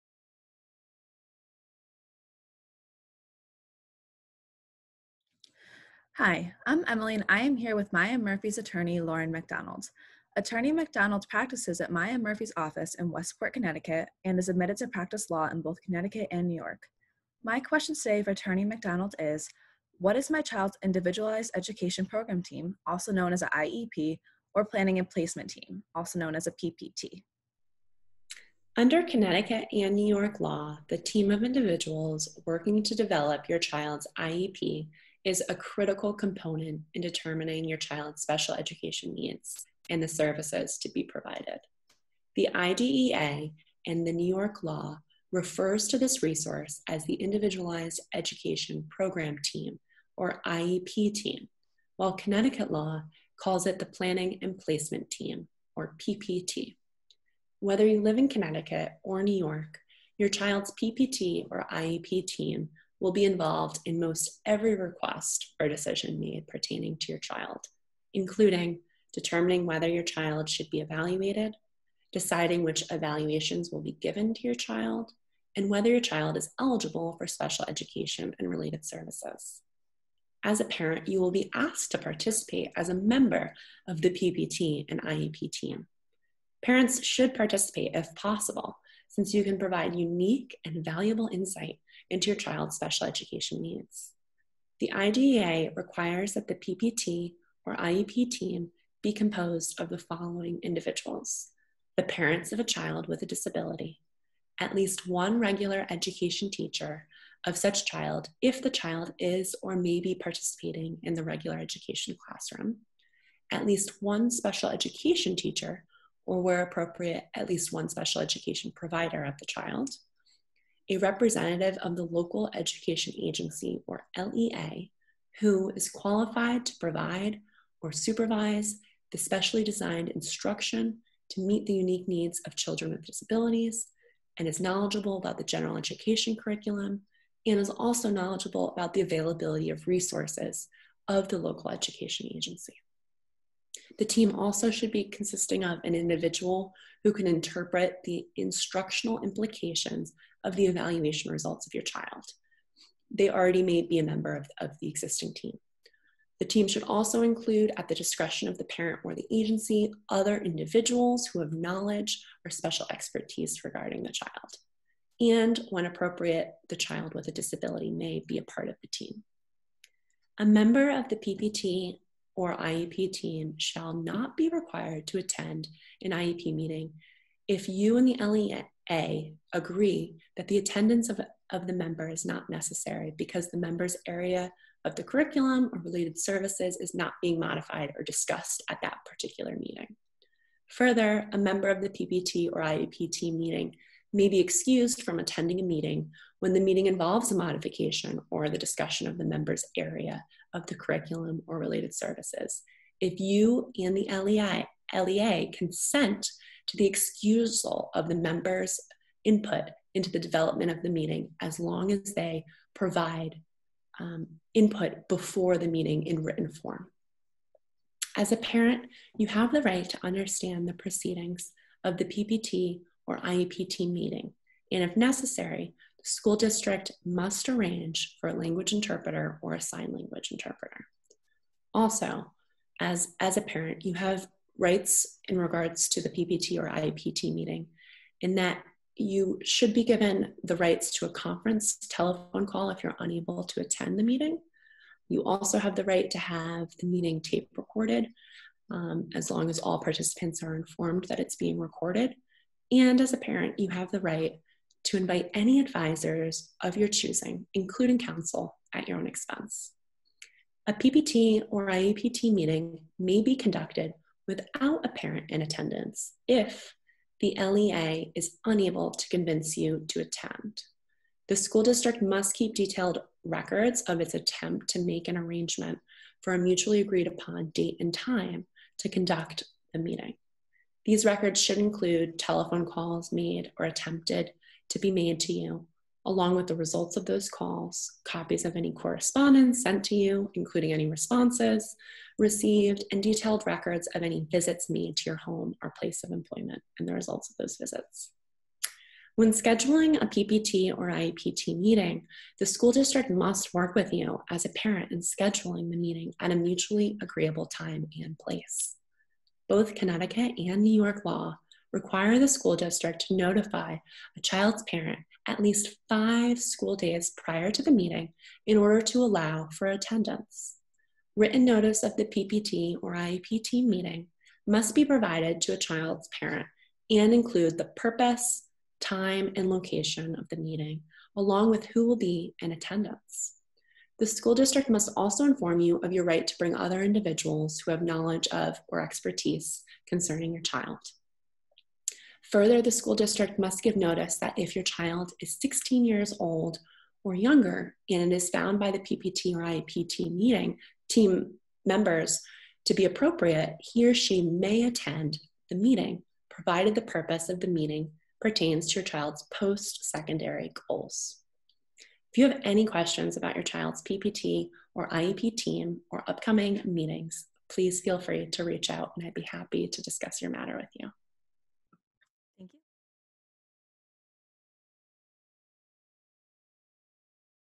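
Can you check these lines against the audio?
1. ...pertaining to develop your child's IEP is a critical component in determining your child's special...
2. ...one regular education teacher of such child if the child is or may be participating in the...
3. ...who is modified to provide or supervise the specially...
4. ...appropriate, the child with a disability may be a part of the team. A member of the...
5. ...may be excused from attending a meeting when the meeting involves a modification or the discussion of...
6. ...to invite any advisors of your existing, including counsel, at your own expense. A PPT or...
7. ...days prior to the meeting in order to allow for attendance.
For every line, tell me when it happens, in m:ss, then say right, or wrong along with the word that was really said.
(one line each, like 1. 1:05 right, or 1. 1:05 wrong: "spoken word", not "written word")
1. 0:32 wrong: "working", not "pertaining"
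2. 1:45 right
3. 2:05 wrong: "qualified", not "modified"
4. 2:45 right
5. 3:14 right
6. 4:14 wrong: "choosing", not "existing"
7. 5:16 right.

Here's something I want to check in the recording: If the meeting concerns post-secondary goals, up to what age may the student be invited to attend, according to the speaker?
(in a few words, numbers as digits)
16.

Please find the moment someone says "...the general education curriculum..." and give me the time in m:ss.
2:15.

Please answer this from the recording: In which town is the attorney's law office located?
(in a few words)
Westport.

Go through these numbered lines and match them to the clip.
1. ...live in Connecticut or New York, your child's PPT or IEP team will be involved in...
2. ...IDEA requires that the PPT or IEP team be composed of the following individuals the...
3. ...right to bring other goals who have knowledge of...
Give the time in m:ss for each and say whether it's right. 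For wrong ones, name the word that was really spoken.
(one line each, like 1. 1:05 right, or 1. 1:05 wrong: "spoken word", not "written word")
1. 0:58 right
2. 1:34 right
3. 5:36 wrong: "individuals", not "goals".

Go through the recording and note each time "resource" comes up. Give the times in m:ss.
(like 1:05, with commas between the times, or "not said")
0:46, 2:19.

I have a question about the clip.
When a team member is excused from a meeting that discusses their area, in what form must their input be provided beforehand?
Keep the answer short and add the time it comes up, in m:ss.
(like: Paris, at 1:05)
written form, at 3:36.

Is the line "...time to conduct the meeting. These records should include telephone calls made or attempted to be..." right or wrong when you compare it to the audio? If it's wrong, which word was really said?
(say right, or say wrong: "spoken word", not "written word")
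right.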